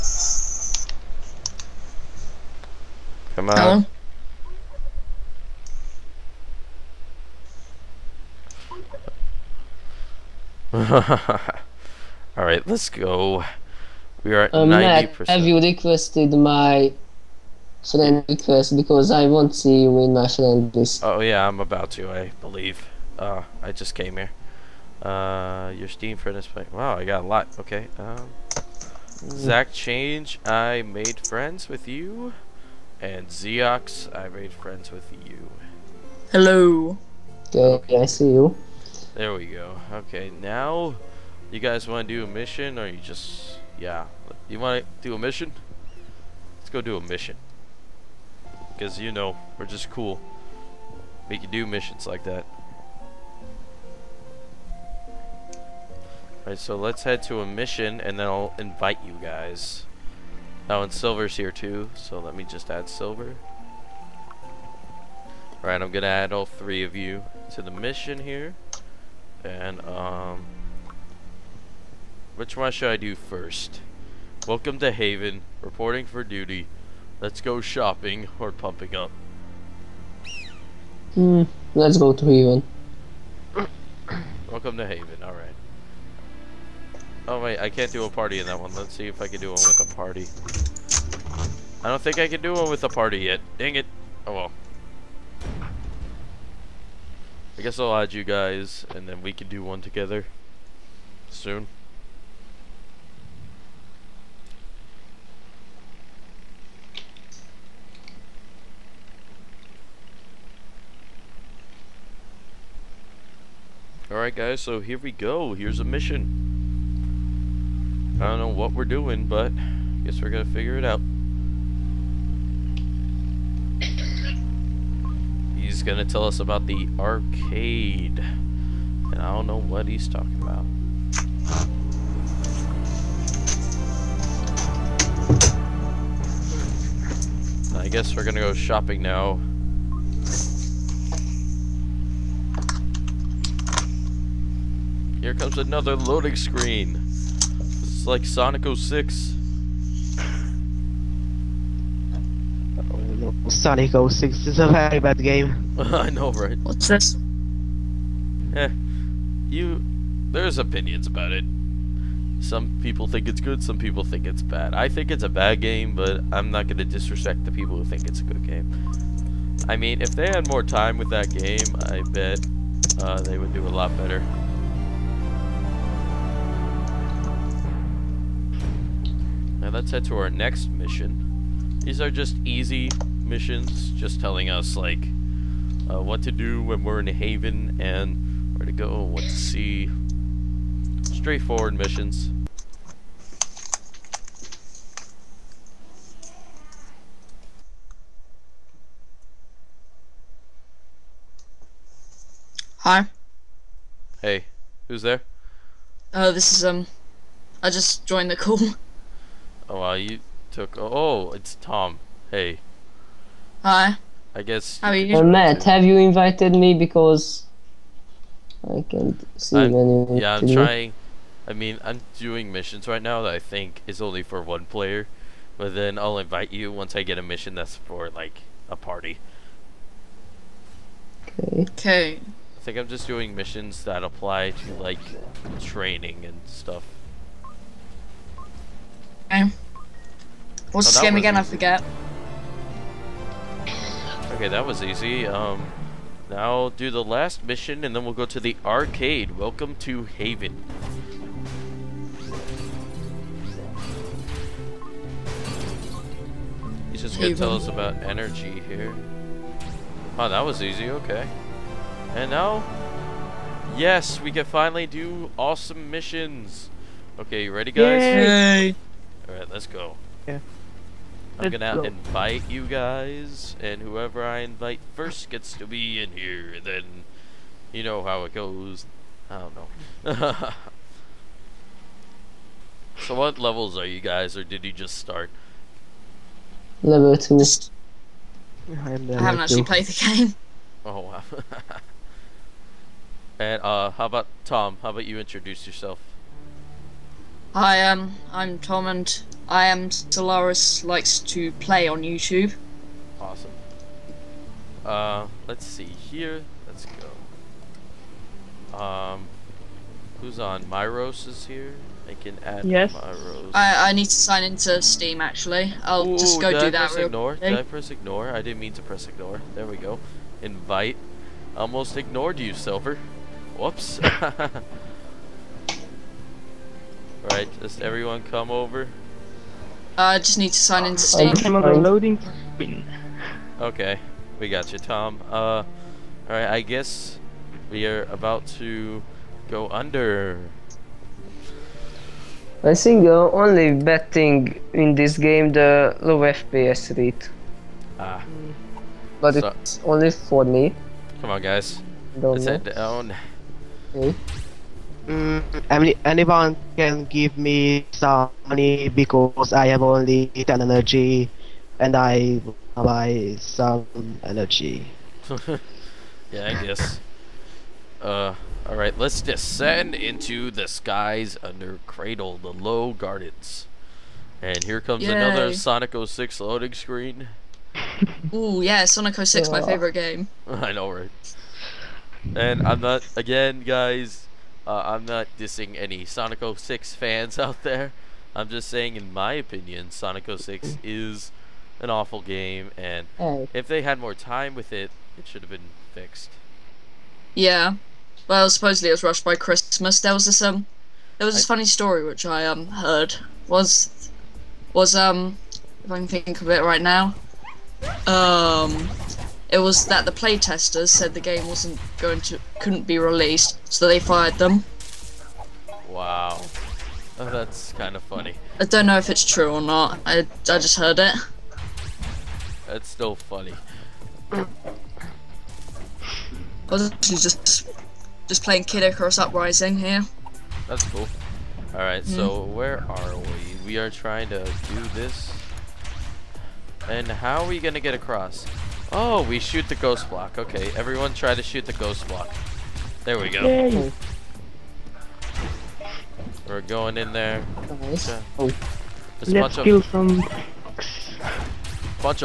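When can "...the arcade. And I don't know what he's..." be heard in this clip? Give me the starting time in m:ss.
2:06.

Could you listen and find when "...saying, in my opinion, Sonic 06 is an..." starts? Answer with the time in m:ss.
6:28.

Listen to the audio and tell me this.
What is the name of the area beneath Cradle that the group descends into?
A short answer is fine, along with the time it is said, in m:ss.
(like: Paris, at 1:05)
the low gardens, at 6:12.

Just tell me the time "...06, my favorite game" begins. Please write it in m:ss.
6:19.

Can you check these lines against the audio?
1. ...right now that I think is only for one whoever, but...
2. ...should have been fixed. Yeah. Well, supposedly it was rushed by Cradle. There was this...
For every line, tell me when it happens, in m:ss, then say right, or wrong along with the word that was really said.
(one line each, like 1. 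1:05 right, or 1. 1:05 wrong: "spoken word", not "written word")
1. 3:42 wrong: "player", not "whoever"
2. 6:35 wrong: "Christmas", not "Cradle".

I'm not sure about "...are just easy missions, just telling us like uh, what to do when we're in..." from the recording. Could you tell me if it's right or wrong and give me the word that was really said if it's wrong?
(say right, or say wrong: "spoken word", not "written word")
right.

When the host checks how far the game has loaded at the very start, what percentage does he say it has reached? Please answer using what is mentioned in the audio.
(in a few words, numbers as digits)
90%.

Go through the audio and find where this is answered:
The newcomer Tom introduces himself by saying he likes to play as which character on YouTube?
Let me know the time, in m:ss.
4:59.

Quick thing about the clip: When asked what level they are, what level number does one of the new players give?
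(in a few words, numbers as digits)
2.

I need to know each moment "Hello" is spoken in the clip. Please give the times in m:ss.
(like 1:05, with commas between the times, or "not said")
0:10, 0:36.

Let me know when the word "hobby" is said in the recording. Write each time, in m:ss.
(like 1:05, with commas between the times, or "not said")
not said.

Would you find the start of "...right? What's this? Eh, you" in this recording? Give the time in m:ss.
2:36.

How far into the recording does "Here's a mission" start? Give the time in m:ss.
1:55.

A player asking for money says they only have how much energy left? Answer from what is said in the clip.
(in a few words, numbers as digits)
10.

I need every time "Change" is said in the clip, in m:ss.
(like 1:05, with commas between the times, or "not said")
0:29.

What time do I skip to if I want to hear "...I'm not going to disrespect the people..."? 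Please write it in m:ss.
2:46.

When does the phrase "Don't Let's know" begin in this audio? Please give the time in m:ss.
5:52.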